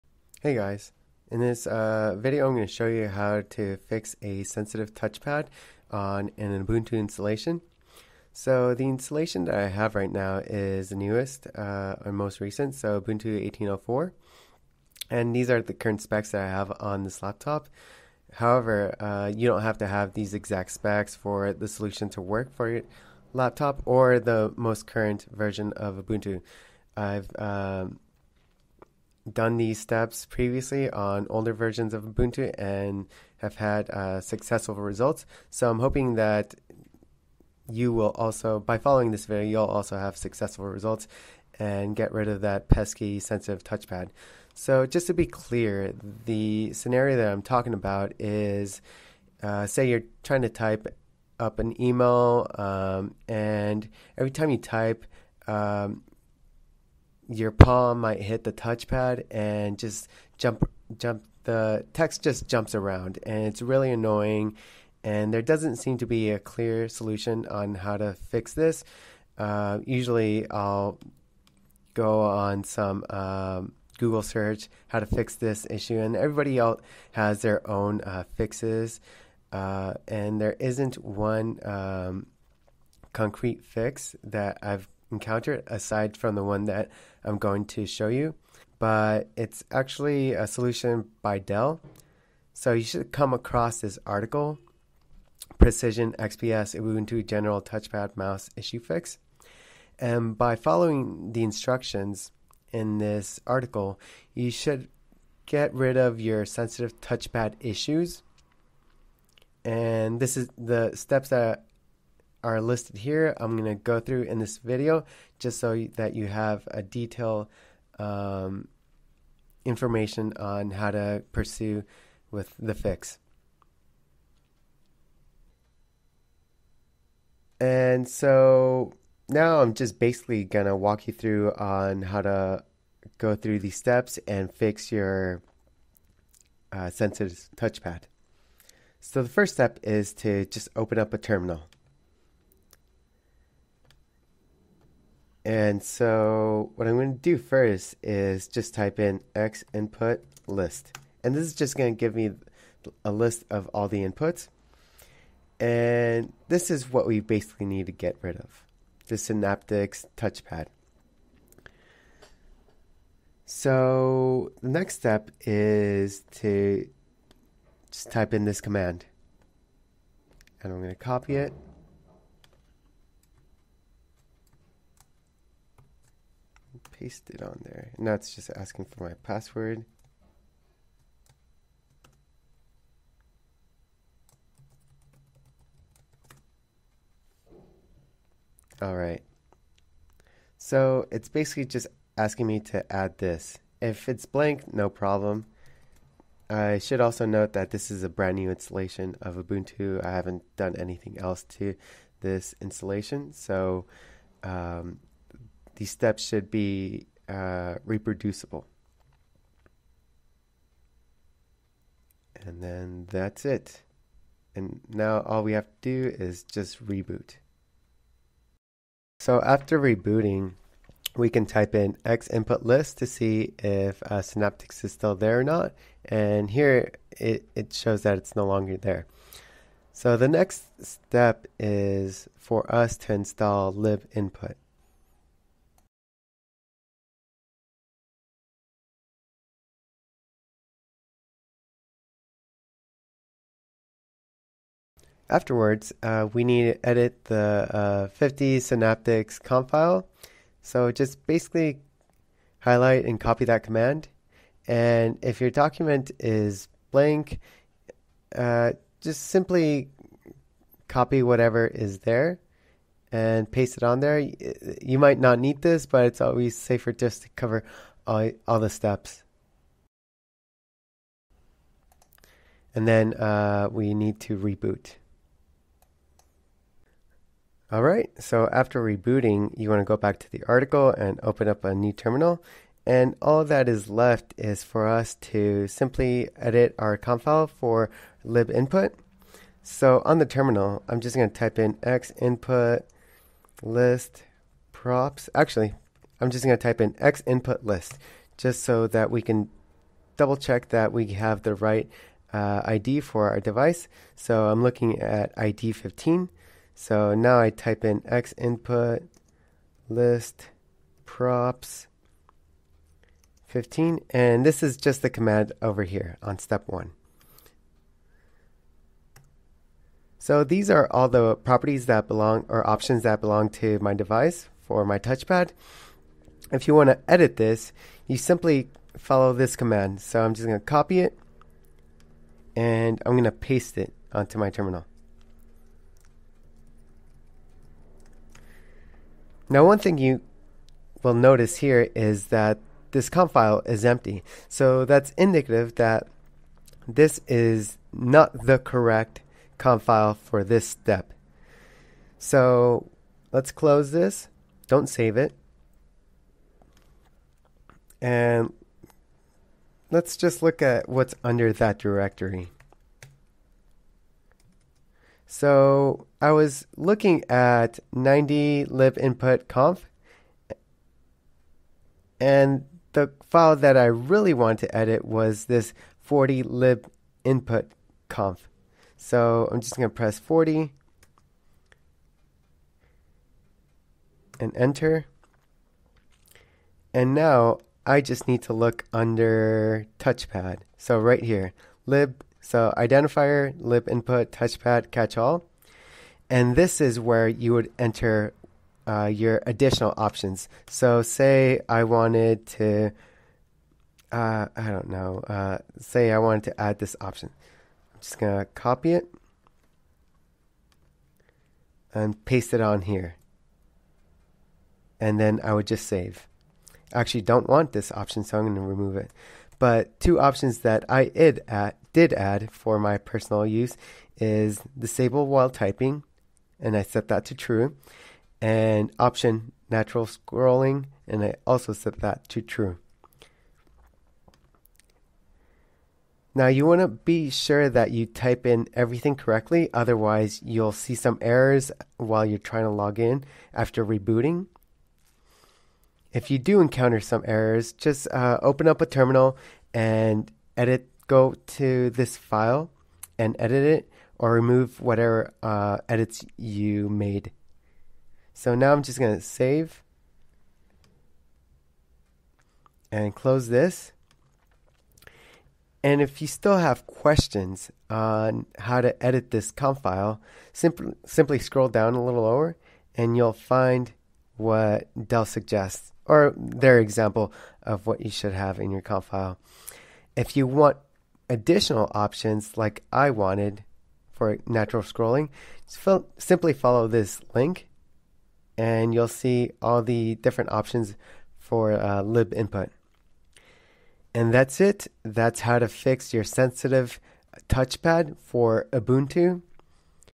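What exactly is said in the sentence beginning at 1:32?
So you should come across this article Precision XPS Ubuntu General Touchpad Mouse Issue Fix.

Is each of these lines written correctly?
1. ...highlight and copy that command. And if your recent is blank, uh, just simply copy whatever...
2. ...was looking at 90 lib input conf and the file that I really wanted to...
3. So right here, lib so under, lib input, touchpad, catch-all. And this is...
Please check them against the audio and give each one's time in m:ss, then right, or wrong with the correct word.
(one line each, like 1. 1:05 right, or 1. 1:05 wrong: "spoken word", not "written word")
1. 4:12 wrong: "document", not "recent"
2. 6:06 right
3. 6:30 wrong: "identifier", not "under".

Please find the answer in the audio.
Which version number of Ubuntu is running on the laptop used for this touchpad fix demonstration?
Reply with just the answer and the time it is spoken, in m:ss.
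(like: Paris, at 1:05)
18.04, at 0:13.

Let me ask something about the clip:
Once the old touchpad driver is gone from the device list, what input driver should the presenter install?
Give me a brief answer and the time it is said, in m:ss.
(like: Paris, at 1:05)
libinput, at 3:53.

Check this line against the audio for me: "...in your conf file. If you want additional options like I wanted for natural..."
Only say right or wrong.
right.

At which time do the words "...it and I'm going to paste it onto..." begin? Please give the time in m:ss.
5:31.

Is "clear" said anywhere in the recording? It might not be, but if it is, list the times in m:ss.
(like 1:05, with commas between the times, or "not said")
0:45, 1:06.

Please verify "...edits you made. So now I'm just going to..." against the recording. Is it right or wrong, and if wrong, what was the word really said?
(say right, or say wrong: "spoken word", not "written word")
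right.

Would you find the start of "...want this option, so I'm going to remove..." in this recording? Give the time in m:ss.
6:57.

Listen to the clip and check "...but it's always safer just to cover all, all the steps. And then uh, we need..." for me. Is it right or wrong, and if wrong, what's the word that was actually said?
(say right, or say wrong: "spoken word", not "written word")
right.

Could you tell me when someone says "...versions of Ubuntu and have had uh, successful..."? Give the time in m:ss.
0:31.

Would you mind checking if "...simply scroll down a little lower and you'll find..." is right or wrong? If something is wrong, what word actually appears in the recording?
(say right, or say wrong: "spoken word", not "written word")
right.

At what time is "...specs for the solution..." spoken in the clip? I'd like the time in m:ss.
0:20.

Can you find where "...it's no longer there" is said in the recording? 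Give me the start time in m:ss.
3:48.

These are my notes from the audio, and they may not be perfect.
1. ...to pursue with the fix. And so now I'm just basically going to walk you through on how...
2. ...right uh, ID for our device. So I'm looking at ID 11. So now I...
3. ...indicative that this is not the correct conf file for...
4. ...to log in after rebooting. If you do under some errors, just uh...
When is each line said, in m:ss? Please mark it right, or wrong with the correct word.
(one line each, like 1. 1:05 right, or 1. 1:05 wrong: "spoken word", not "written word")
1. 2:00 right
2. 5:01 wrong: "15", not "11"
3. 5:45 right
4. 7:22 wrong: "encounter", not "under".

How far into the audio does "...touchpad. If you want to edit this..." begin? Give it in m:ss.
5:24.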